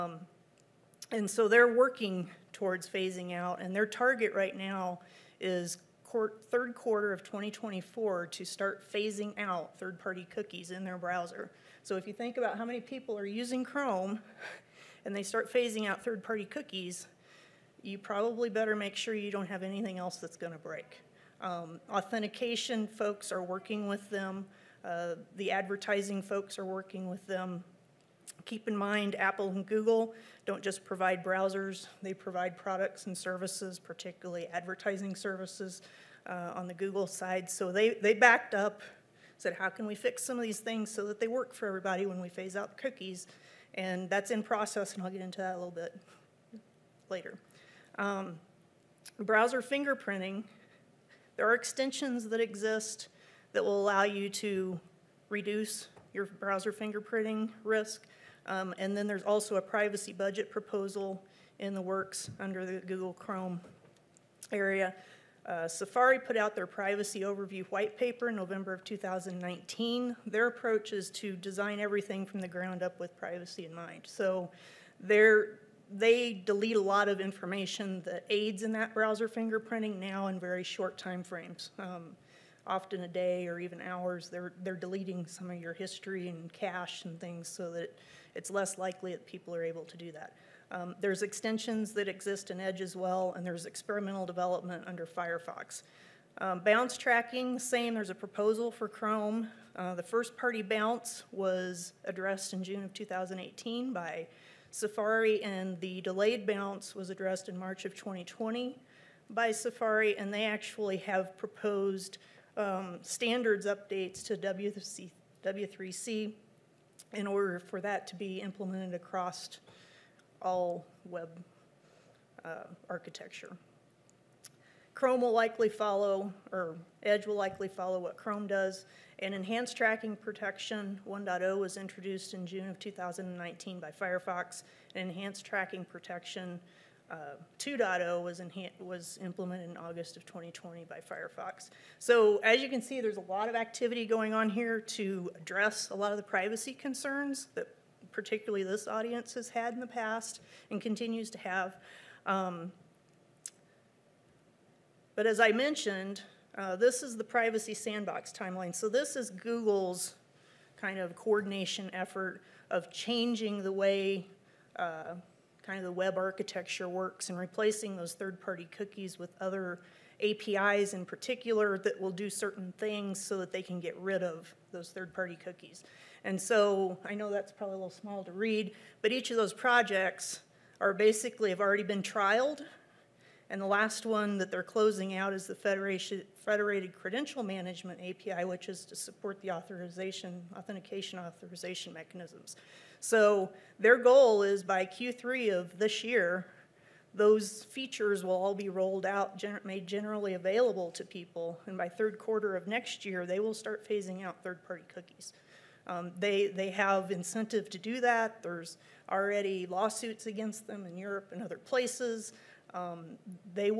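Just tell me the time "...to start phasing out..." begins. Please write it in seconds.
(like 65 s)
8 s.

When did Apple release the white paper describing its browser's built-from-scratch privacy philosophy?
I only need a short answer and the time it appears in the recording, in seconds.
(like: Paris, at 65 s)
November 2019, at 68 s.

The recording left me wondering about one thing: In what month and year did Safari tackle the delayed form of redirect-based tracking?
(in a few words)
March 2020.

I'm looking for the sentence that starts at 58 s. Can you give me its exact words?
Um, and then there's also a privacy budget proposal in the works under the Google Chrome area.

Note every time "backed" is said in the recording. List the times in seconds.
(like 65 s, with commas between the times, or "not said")
38 s.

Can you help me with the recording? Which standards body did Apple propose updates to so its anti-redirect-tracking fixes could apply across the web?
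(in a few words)
W3C.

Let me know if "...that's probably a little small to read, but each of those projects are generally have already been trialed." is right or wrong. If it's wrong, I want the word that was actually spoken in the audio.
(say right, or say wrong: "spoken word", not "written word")
wrong: "basically", not "generally".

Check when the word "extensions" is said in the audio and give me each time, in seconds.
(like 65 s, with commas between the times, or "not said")
51 s, 91 s.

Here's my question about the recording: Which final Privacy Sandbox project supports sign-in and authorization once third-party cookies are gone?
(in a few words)
Federated Credential Management API.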